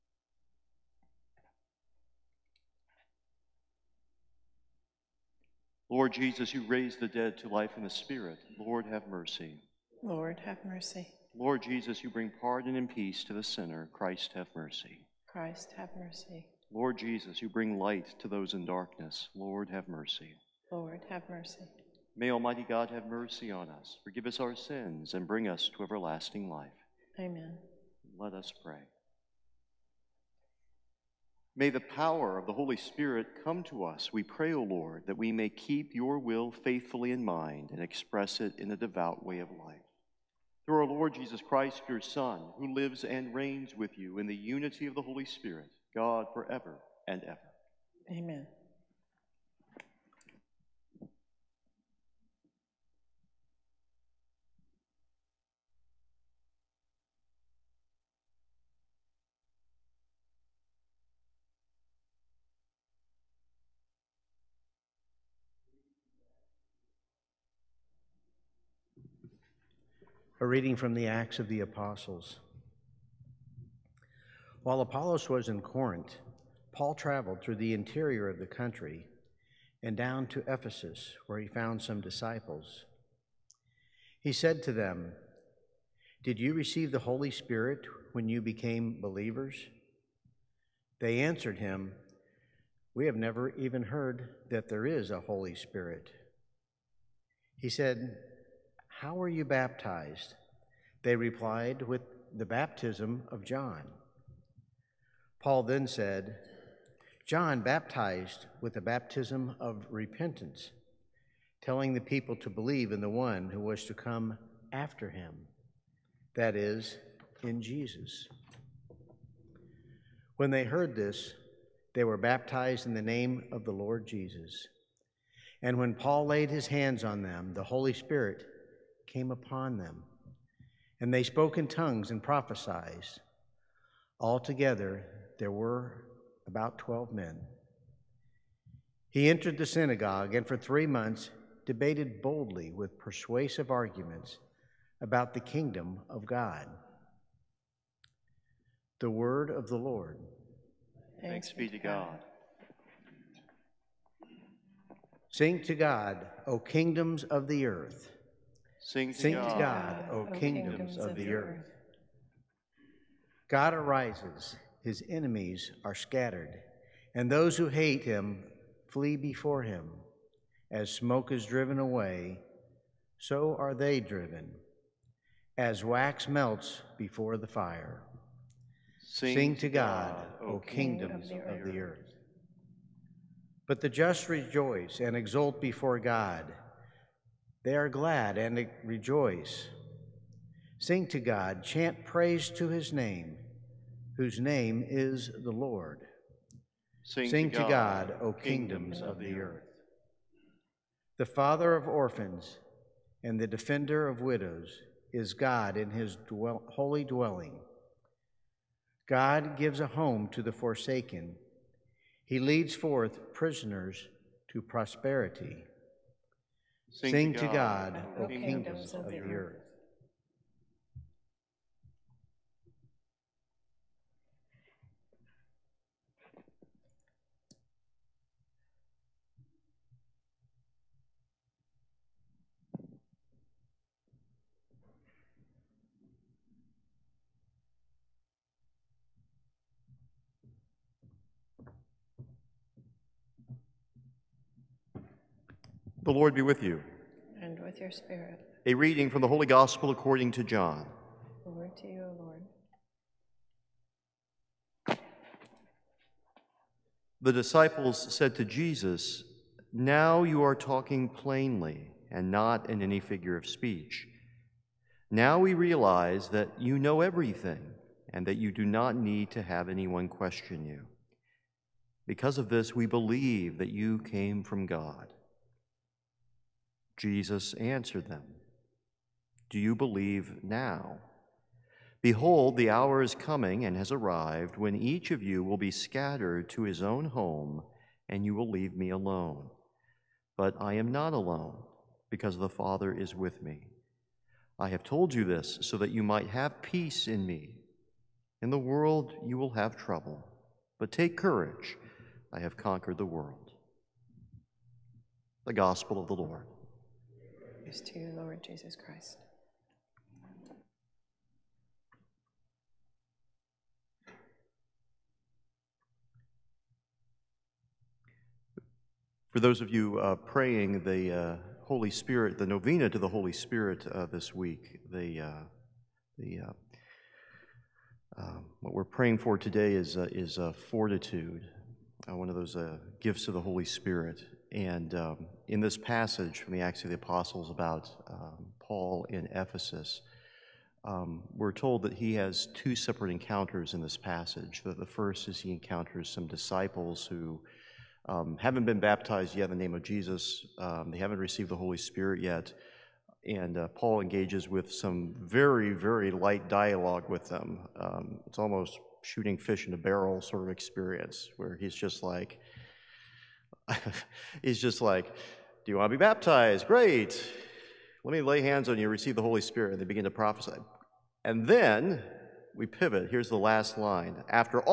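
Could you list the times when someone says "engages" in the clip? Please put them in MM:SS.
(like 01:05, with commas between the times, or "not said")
05:53.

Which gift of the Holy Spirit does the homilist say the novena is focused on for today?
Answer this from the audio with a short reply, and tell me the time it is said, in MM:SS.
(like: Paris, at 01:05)
fortitude, at 05:30.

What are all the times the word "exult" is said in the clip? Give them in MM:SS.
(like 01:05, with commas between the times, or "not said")
03:05.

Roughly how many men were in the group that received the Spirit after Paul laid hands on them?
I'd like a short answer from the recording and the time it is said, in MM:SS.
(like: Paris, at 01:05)
12, at 02:16.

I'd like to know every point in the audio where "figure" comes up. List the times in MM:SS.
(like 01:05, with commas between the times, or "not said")
04:22.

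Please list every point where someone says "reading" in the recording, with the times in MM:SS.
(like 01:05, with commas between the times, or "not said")
01:10, 04:08.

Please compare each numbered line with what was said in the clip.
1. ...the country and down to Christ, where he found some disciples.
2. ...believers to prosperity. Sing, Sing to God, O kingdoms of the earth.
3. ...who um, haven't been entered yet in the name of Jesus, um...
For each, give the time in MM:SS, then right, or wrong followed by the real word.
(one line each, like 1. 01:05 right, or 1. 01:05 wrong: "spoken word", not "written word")
1. 01:18 wrong: "Ephesus", not "Christ"
2. 03:33 wrong: "prisoners", not "believers"
3. 05:47 wrong: "baptized", not "entered".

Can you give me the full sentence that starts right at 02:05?
And when Paul laid his hands on them, the Holy Spirit came upon them, and they spoke in tongues and prophesied.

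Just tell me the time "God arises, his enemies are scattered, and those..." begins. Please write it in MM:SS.
02:43.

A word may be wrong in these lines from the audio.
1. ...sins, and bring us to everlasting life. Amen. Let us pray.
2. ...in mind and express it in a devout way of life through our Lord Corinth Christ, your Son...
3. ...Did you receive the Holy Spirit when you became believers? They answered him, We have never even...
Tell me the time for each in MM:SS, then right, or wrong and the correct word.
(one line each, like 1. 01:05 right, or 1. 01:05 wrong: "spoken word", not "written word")
1. 00:24 right
2. 00:37 wrong: "Jesus", not "Corinth"
3. 01:26 right.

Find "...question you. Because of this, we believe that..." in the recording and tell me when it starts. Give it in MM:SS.
04:30.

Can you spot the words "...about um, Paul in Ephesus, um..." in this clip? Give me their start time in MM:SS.
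05:37.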